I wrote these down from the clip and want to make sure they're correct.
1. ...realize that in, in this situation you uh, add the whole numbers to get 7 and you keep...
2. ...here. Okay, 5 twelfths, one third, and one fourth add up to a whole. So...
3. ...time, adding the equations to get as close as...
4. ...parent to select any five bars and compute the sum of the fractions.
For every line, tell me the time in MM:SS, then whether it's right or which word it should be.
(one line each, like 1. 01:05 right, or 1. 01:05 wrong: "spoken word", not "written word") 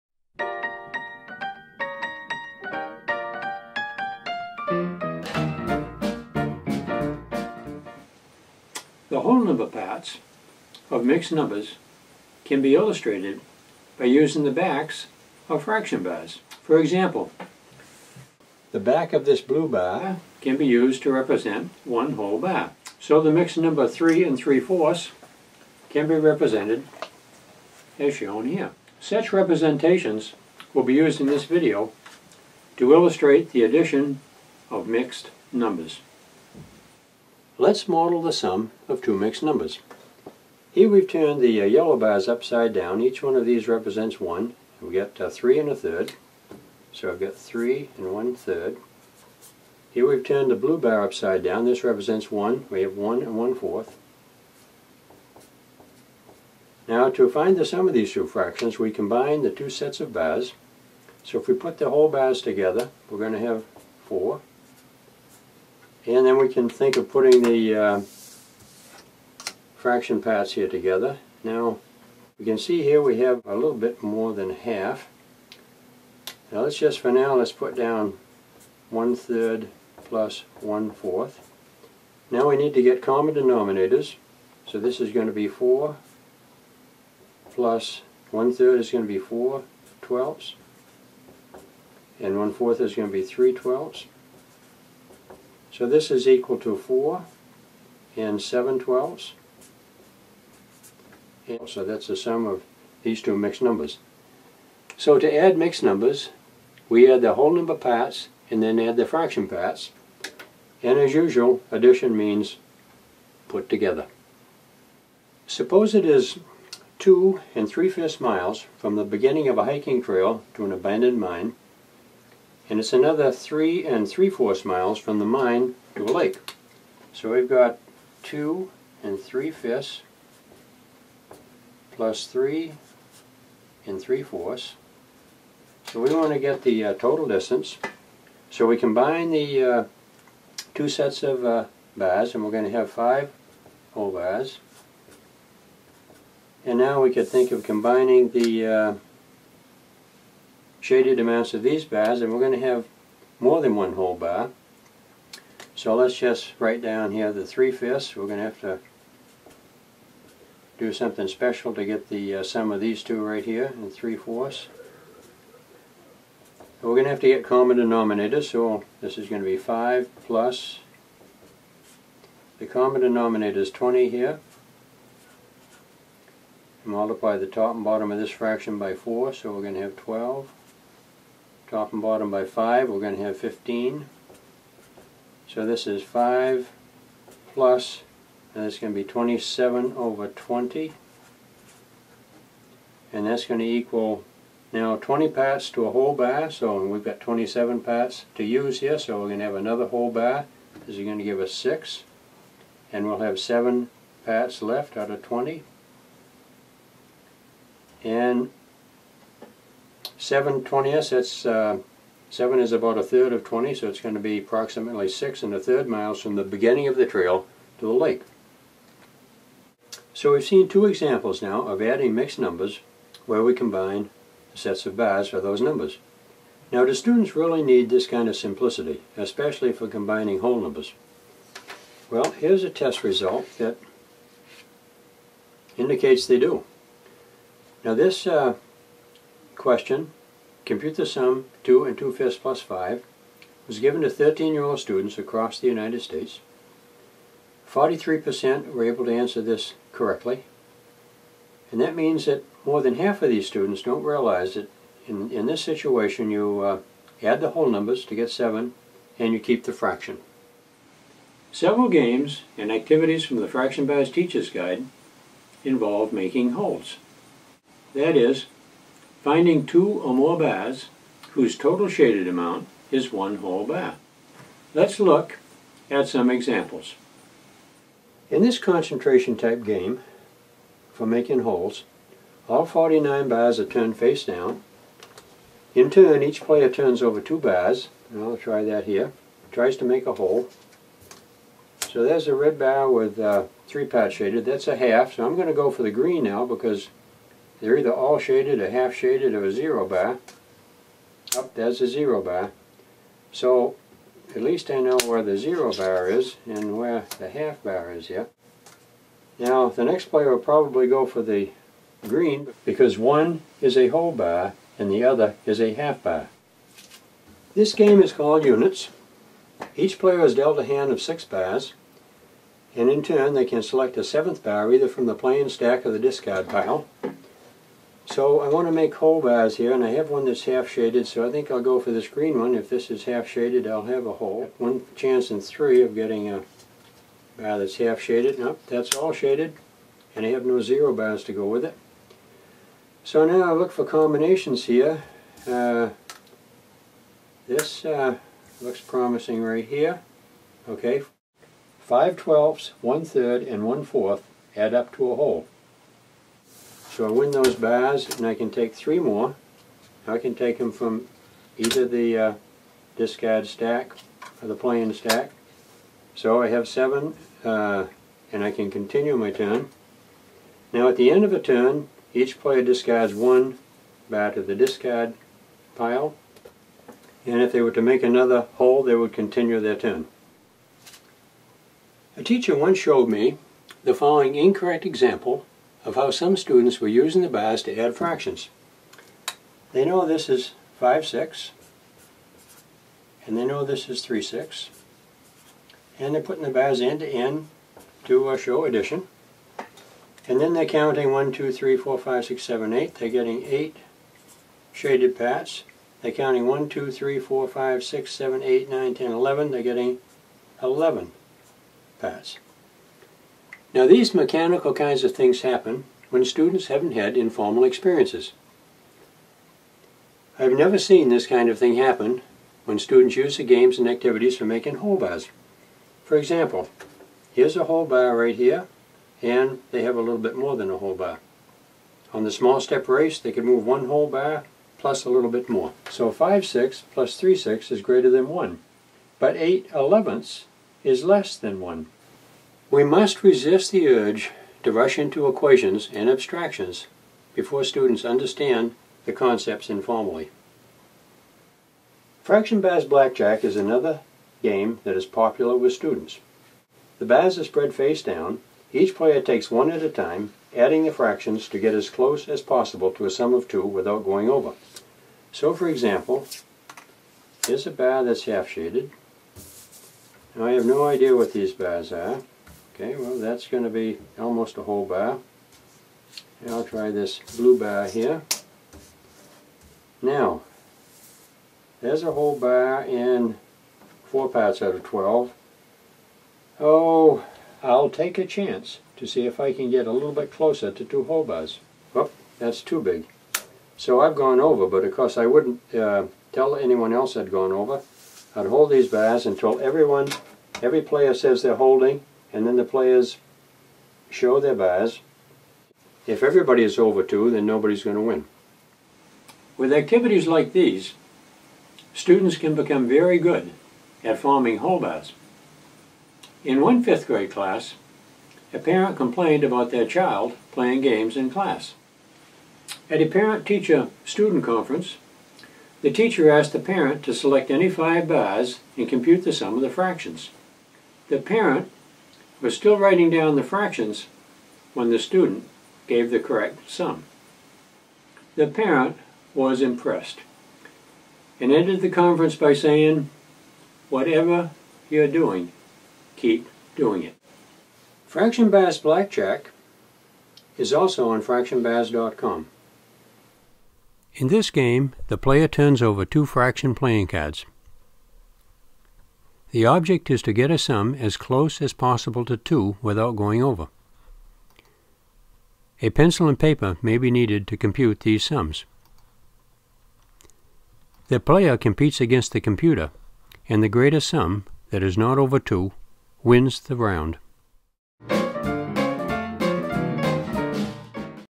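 1. 04:14 right
2. 05:49 right
3. 07:39 wrong: "fractions", not "equations"
4. 08:46 right.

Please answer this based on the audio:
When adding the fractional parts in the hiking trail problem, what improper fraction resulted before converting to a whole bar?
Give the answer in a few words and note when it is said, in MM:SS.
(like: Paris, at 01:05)
27/20, at 03:09.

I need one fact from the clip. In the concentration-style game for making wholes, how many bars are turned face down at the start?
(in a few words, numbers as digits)
49.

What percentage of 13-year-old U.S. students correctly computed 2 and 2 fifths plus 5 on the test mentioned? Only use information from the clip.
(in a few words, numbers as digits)
43%.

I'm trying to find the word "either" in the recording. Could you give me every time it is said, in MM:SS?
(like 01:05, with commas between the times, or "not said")
04:57, 05:24, 06:01.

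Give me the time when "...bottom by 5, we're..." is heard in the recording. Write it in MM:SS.
03:02.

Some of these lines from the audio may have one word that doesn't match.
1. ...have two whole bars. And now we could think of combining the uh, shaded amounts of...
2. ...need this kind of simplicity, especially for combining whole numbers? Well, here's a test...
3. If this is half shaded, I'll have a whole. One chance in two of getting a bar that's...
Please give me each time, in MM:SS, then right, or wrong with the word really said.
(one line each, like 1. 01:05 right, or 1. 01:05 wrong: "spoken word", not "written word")
1. 02:22 wrong: "five", not "two"
2. 03:47 right
3. 05:32 wrong: "three", not "two".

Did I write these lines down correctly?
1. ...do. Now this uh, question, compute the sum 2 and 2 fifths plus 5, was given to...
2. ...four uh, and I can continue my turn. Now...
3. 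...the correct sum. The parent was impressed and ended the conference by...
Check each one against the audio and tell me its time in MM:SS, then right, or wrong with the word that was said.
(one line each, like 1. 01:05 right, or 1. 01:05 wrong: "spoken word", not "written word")
1. 03:56 right
2. 06:06 wrong: "seven", not "four"
3. 08:56 right.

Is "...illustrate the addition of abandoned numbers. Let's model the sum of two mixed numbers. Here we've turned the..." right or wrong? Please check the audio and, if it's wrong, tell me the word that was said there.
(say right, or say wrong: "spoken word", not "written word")
wrong: "mixed", not "abandoned".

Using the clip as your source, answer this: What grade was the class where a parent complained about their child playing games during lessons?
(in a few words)
fifth grade.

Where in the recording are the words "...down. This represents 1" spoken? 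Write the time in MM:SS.
00:51.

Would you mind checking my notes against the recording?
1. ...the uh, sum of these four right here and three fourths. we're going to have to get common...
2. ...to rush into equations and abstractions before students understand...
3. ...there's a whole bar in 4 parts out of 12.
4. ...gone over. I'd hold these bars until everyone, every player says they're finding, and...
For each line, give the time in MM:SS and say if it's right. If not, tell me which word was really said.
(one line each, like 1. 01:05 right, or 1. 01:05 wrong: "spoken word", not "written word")
1. 02:42 wrong: "two", not "four"
2. 07:24 right
3. 08:01 right
4. 08:17 wrong: "holding", not "finding".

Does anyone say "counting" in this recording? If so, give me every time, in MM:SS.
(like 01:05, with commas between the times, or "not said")
06:40, 06:46.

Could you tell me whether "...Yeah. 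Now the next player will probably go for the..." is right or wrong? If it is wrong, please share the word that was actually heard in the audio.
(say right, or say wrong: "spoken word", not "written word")
right.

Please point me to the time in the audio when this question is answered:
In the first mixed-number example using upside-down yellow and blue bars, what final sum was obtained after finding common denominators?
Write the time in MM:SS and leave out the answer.
01:36.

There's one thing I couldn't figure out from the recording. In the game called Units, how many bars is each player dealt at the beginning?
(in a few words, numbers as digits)
6.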